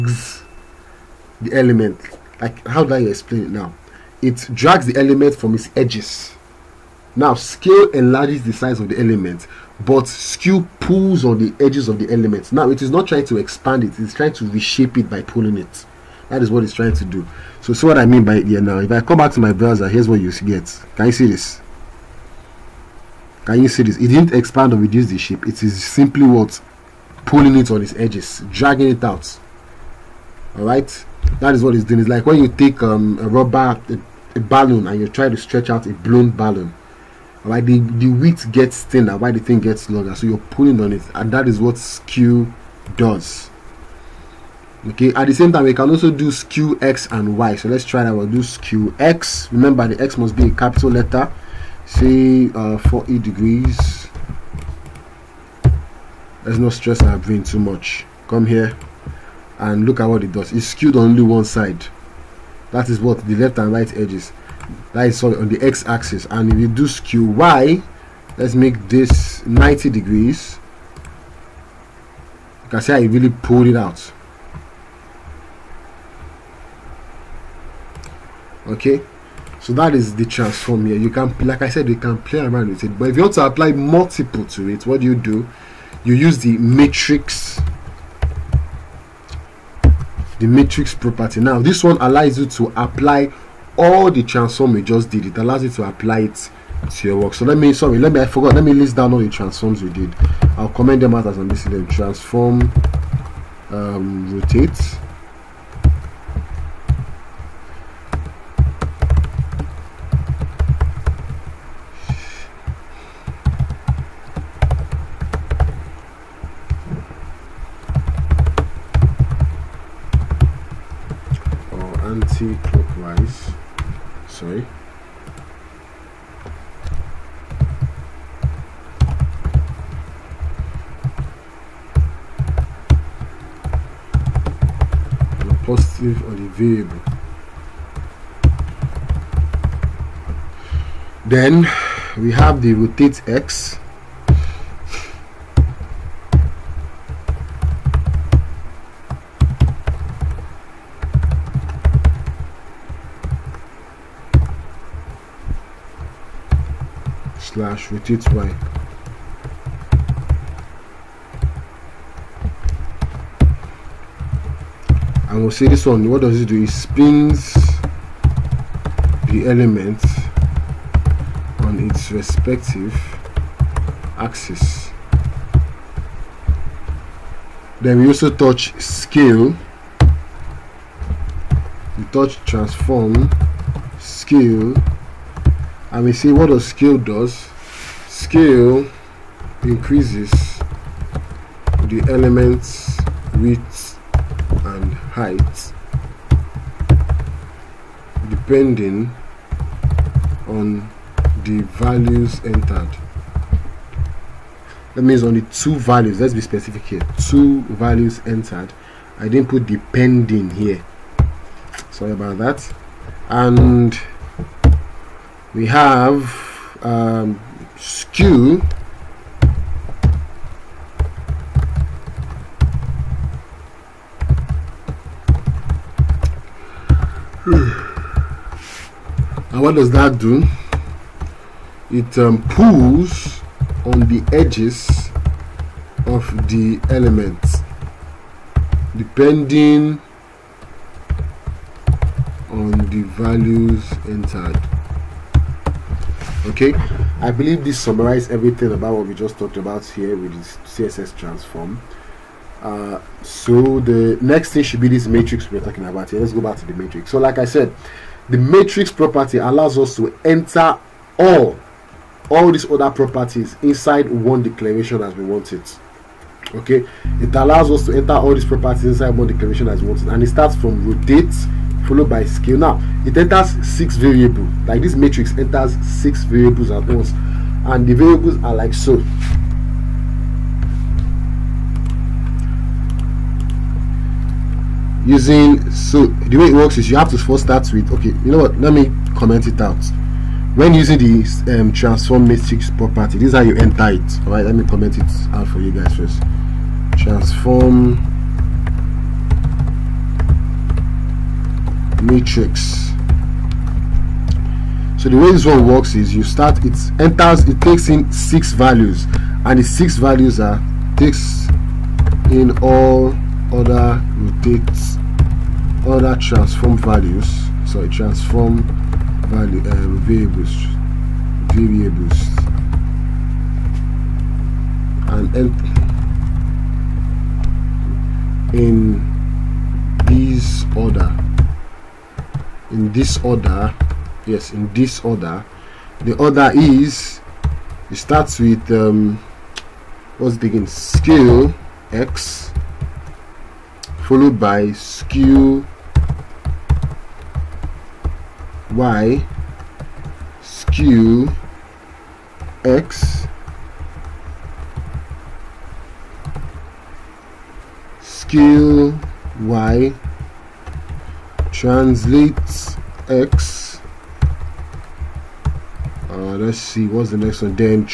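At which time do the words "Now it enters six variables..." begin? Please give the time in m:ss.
4:32.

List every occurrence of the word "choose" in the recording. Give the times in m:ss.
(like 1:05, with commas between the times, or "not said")
not said.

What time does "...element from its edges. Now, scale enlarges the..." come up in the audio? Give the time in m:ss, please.
0:04.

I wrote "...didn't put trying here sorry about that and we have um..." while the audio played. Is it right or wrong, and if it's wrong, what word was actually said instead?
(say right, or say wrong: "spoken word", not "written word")
wrong: "depending", not "trying".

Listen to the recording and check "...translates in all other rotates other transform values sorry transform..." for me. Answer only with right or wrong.
wrong.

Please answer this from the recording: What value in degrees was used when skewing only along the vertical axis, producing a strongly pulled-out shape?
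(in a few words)
90.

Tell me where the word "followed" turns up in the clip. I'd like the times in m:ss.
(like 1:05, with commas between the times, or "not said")
4:31, 5:44.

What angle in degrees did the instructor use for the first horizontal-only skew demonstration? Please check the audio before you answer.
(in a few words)
40.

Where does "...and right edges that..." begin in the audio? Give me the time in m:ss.
1:03.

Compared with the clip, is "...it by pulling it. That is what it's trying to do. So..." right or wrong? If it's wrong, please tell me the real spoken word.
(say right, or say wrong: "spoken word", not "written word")
right.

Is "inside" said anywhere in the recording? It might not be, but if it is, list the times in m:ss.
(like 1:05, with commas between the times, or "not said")
4:23, 4:28.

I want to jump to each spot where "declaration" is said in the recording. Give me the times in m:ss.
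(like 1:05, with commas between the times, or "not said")
4:24, 4:29.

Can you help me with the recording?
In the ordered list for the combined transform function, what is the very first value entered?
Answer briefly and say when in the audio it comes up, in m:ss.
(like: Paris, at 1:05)
scale x, at 5:40.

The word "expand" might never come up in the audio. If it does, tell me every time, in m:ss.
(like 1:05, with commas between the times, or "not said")
0:13, 0:24.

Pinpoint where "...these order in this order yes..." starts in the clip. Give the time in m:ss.
5:30.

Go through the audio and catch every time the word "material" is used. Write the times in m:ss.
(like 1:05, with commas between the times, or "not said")
not said.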